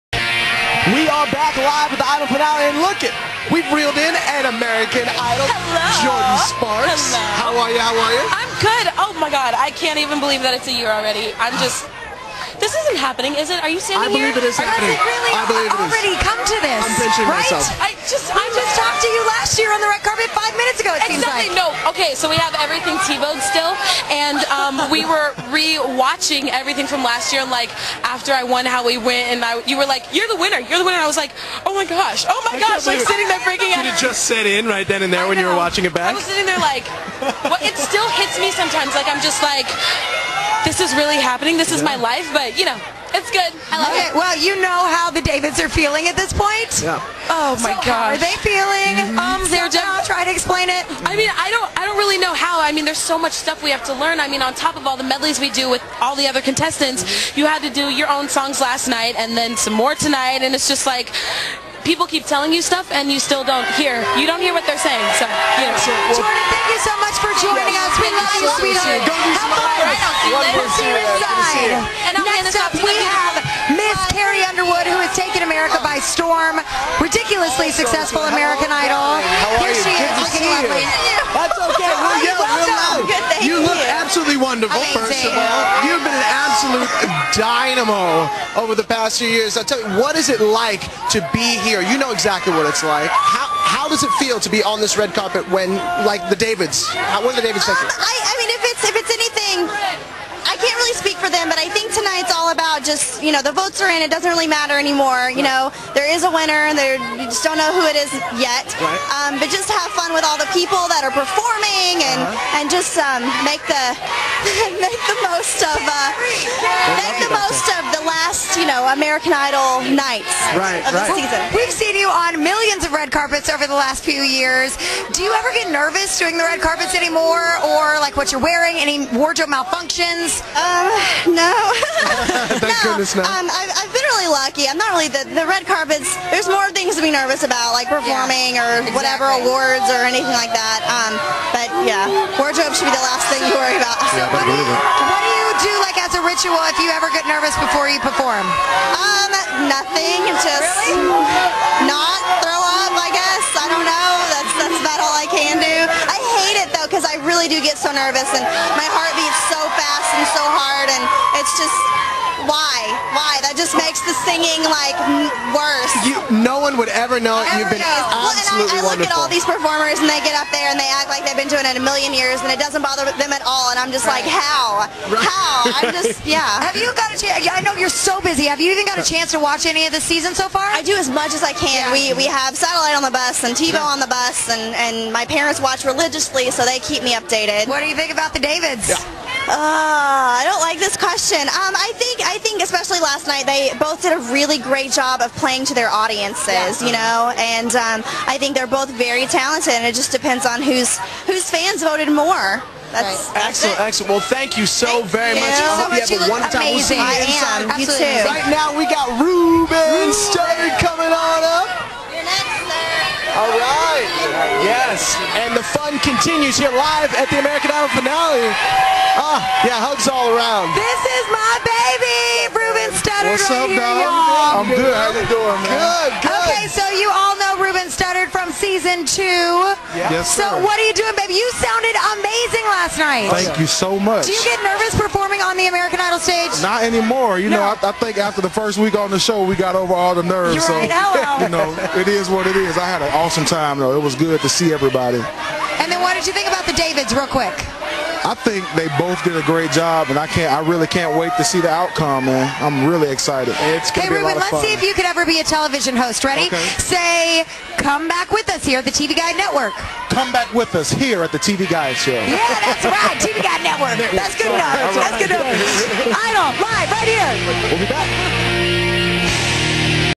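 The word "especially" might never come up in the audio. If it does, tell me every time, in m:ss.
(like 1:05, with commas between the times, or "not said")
3:12.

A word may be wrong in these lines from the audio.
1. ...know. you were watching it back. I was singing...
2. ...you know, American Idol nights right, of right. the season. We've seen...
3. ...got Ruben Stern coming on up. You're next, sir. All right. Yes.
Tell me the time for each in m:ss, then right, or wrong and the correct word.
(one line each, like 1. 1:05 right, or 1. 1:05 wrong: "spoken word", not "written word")
1. 0:35 wrong: "sitting", not "singing"
2. 1:58 right
3. 3:28 right.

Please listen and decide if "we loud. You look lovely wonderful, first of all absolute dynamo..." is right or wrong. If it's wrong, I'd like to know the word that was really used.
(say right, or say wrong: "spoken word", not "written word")
wrong: "absolutely", not "lovely".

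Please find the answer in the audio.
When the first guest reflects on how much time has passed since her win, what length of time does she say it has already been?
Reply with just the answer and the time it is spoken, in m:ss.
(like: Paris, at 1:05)
a year, at 0:10.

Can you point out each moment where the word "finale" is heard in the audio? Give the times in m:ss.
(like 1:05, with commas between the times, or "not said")
0:02, 3:37.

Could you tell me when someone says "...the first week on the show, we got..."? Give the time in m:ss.
3:58.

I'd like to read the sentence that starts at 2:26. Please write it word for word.
ritual if you ever get nervous before you perform?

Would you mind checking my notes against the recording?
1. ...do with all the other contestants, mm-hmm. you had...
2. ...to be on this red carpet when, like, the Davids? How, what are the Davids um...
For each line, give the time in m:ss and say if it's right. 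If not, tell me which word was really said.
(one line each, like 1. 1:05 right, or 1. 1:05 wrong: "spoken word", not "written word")
1. 0:55 right
2. 1:34 right.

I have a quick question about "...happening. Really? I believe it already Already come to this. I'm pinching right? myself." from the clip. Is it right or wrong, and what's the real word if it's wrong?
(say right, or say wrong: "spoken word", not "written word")
right.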